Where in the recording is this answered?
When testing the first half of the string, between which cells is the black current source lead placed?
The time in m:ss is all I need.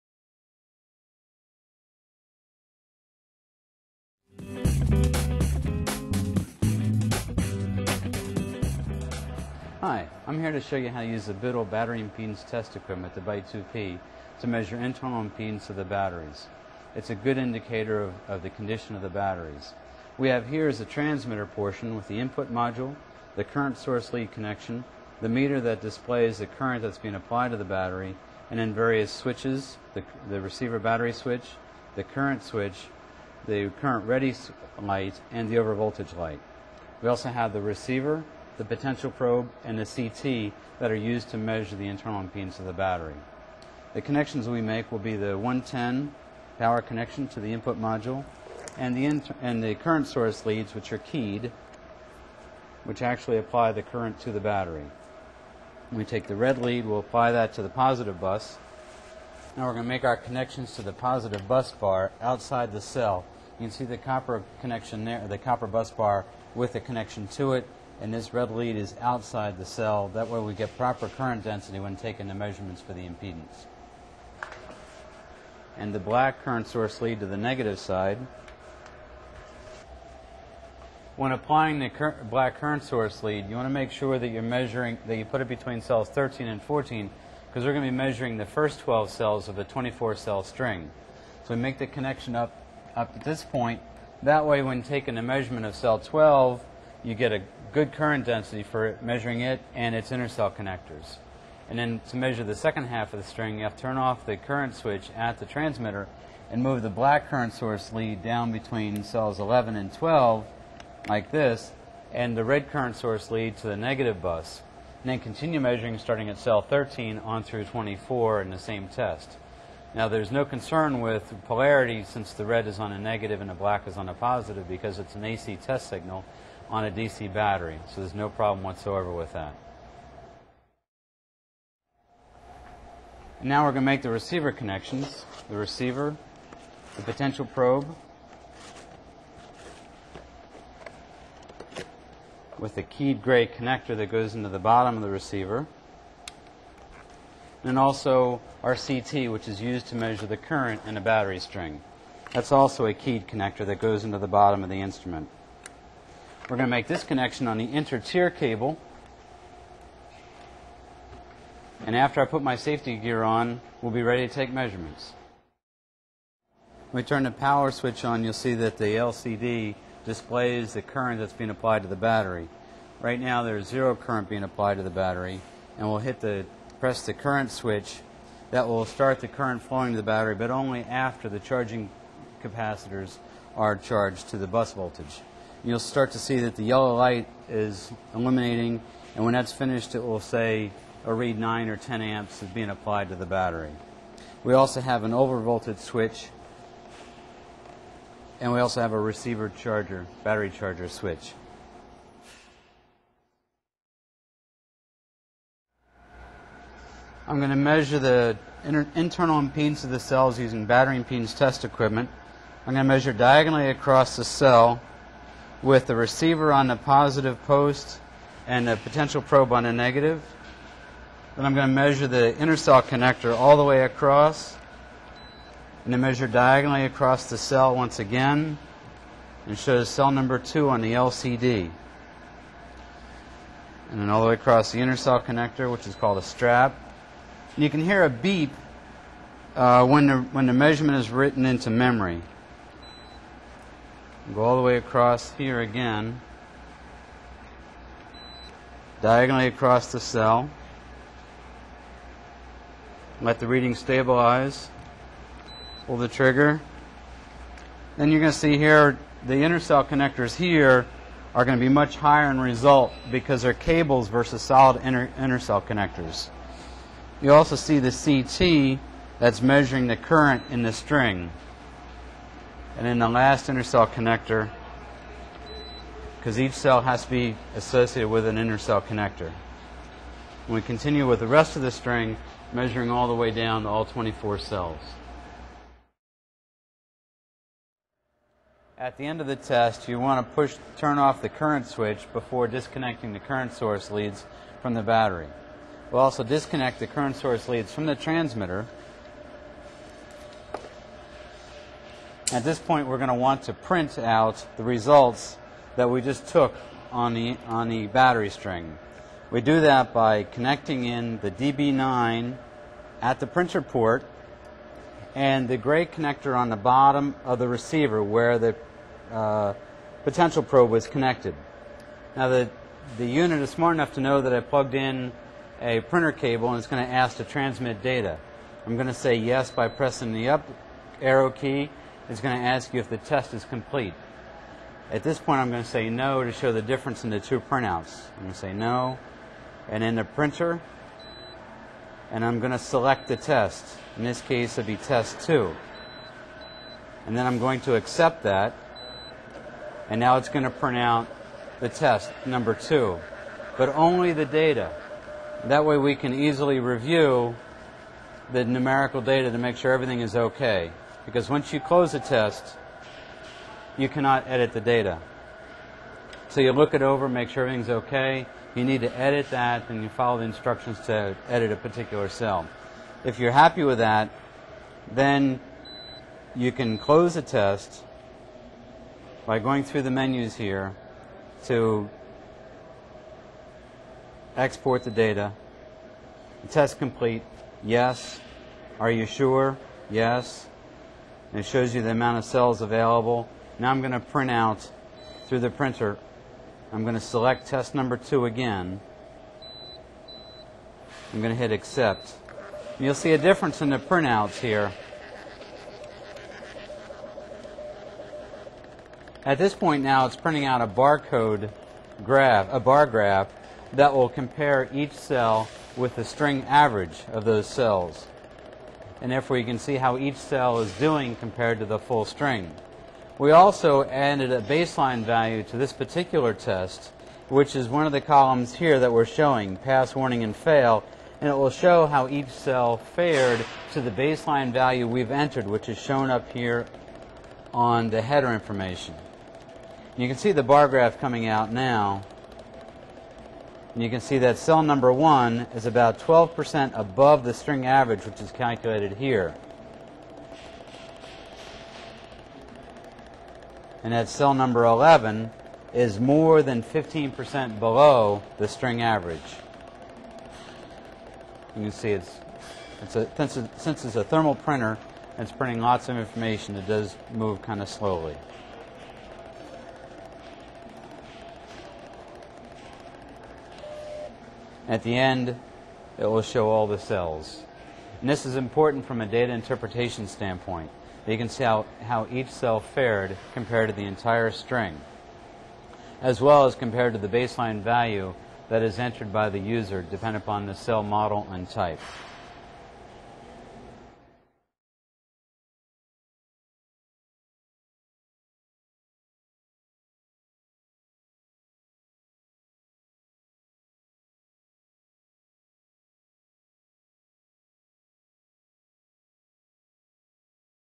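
1:26.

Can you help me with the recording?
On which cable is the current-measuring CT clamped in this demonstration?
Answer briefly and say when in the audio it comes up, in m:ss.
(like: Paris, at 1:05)
inter-tier cable, at 2:37.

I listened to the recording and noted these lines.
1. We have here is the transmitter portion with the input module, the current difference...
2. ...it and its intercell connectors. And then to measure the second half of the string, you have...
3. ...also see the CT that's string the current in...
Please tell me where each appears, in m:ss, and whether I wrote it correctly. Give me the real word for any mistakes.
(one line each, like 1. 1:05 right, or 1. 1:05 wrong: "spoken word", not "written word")
1. 0:20 wrong: "source", not "difference"
2. 1:39 right
3. 4:27 wrong: "measuring", not "string".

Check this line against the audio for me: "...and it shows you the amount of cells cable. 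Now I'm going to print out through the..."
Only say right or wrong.
wrong.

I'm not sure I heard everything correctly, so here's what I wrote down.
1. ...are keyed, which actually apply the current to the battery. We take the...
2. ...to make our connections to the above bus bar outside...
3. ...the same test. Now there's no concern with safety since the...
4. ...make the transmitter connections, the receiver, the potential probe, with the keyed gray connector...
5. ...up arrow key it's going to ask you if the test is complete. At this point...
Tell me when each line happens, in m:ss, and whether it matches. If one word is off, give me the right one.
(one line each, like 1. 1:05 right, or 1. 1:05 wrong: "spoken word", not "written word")
1. 0:50 right
2. 0:59 wrong: "positive", not "above"
3. 1:58 wrong: "polarity", not "safety"
4. 2:13 wrong: "receiver", not "transmitter"
5. 5:30 right.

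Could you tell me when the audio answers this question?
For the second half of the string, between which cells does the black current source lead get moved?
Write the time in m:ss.
1:49.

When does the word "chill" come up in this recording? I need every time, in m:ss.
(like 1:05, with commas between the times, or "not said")
not said.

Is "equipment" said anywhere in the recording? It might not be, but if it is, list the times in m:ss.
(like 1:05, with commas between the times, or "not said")
0:12, 3:31.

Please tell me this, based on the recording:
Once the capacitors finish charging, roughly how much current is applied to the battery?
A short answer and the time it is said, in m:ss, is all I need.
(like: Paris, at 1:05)
9 or 10 amps, at 3:11.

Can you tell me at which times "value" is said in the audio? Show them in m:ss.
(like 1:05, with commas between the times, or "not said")
7:05, 7:14, 8:07.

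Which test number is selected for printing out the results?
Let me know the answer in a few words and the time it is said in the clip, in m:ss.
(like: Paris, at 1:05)
2, at 5:44.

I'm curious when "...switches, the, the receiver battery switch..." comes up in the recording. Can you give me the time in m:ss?
0:29.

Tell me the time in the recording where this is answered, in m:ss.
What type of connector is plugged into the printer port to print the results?
5:11.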